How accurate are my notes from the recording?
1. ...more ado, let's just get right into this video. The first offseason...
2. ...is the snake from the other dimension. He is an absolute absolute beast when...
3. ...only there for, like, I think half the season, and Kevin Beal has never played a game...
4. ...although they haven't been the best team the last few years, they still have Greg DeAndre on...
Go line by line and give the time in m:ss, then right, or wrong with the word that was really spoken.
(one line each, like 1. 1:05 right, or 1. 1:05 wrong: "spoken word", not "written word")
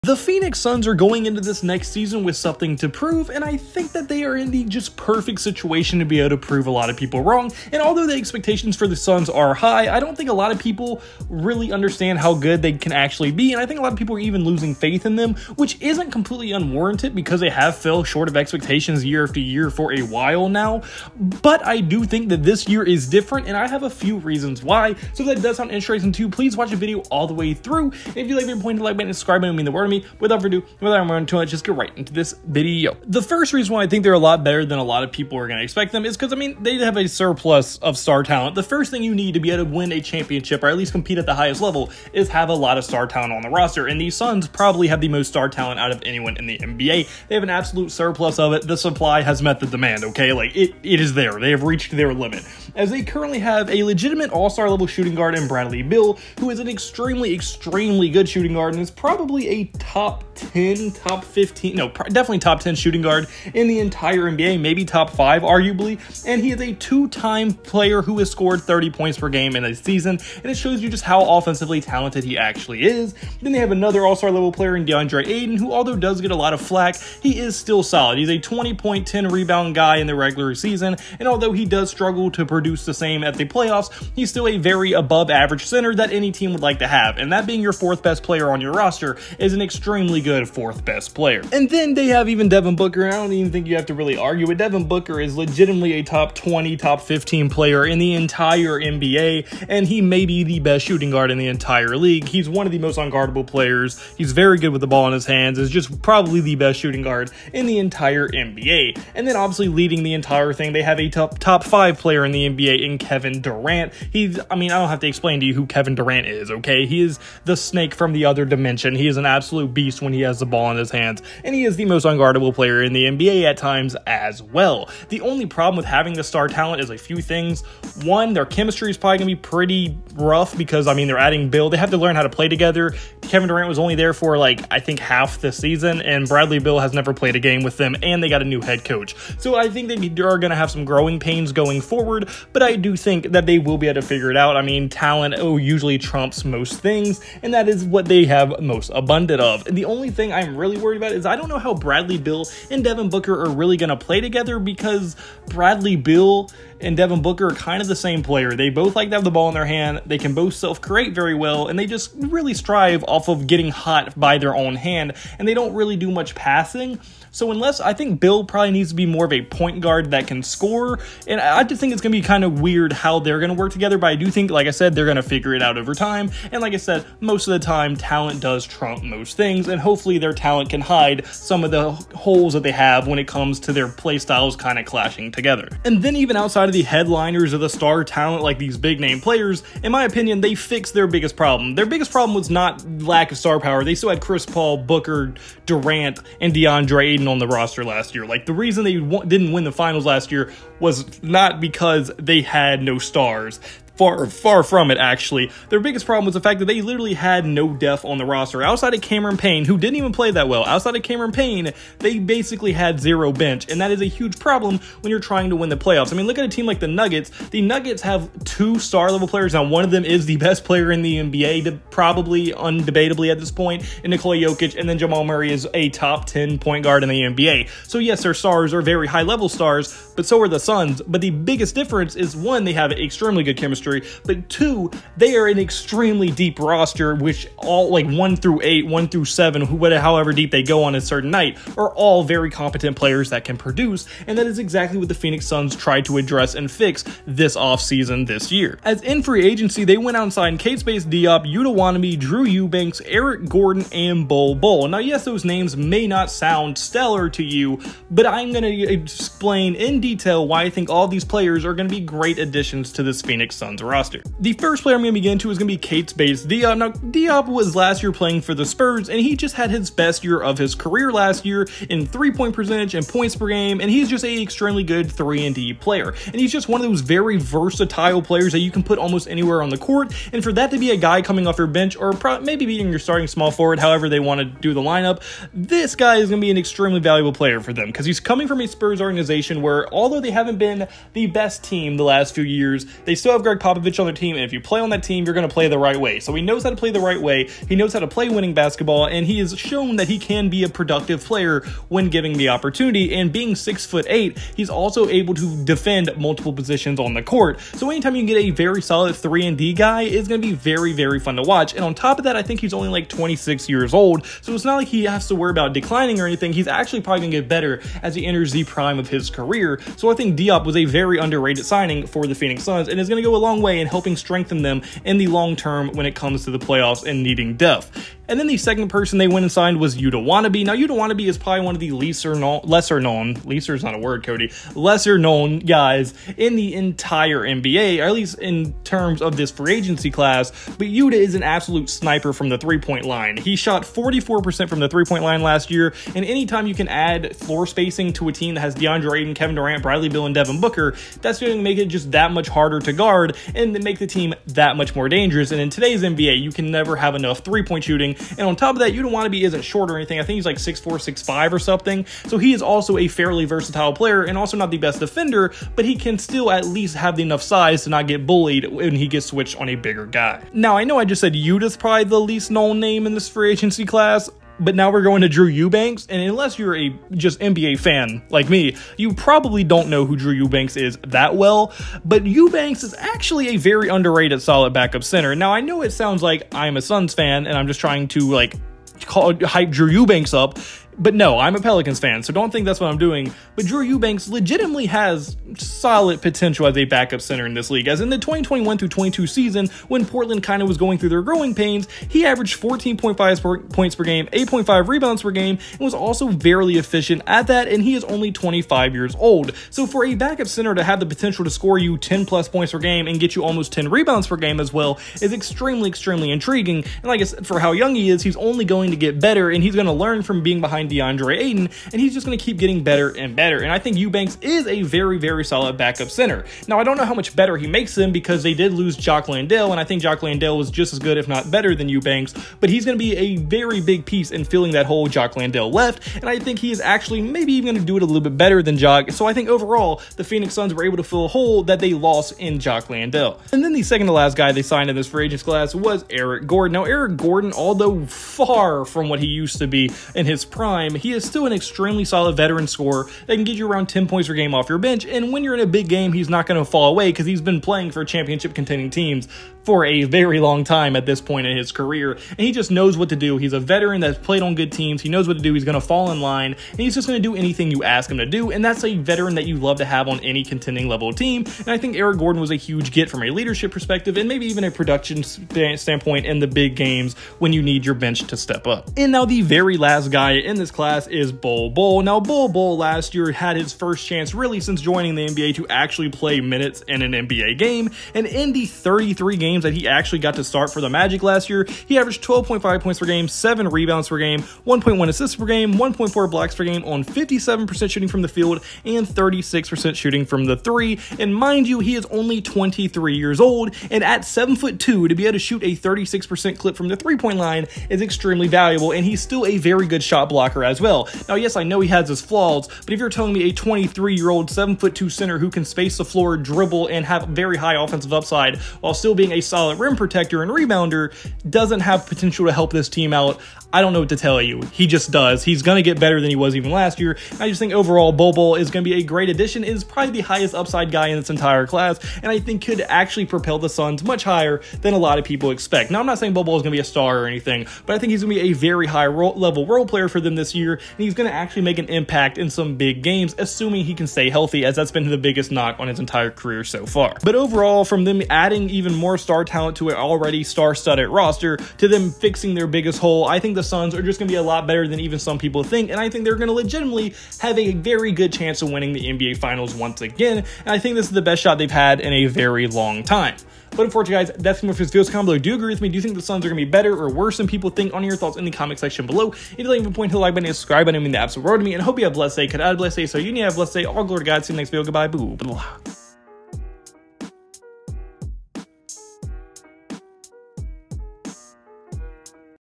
1. 0:31 wrong: "reason", not "offseason"
2. 1:57 right
3. 2:13 wrong: "Bradley", not "Kevin"
4. 4:49 wrong: "Popovich", not "DeAndre".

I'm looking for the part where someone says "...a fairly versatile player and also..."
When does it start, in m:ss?
6:02.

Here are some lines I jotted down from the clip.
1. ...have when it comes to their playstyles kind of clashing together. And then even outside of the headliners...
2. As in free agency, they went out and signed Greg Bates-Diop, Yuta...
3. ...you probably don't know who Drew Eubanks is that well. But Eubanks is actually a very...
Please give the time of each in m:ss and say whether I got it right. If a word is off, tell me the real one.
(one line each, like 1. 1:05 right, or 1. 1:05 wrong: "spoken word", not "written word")
1. 3:02 right
2. 4:08 wrong: "Keita", not "Greg"
3. 6:18 right.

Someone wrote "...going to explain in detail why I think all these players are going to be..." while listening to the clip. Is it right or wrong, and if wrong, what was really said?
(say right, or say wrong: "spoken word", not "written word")
right.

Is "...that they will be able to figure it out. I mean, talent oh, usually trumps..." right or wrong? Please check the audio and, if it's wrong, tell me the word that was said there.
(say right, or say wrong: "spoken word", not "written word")
right.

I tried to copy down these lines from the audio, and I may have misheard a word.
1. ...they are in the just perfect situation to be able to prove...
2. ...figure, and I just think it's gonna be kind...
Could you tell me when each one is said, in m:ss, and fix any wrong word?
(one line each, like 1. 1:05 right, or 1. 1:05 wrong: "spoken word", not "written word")
1. 0:04 right
2. 2:50 wrong: "score", not "figure".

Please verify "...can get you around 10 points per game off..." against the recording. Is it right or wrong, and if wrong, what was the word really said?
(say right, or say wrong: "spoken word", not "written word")
right.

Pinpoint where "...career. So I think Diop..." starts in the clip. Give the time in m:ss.
5:19.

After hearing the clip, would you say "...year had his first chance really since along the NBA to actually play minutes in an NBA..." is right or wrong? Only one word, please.
wrong.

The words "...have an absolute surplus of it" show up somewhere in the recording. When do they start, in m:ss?
0:47.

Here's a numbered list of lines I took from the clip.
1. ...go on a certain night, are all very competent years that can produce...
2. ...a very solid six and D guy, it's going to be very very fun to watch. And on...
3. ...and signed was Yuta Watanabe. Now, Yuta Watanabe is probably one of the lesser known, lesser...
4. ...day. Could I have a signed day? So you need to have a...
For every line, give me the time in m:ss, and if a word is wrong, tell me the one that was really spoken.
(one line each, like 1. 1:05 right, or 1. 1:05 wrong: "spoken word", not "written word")
1. 4:00 wrong: "players", not "years"
2. 5:08 wrong: "three", not "six"
3. 5:29 right
4. 9:32 wrong: "blessed", not "signed".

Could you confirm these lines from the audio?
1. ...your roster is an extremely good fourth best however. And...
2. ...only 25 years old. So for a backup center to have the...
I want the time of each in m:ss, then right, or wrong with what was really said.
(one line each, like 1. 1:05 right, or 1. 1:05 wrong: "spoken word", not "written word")
1. 1:28 wrong: "player", not "however"
2. 6:48 right.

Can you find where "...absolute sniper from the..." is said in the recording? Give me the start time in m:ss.
5:41.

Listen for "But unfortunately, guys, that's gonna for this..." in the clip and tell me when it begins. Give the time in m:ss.
9:23.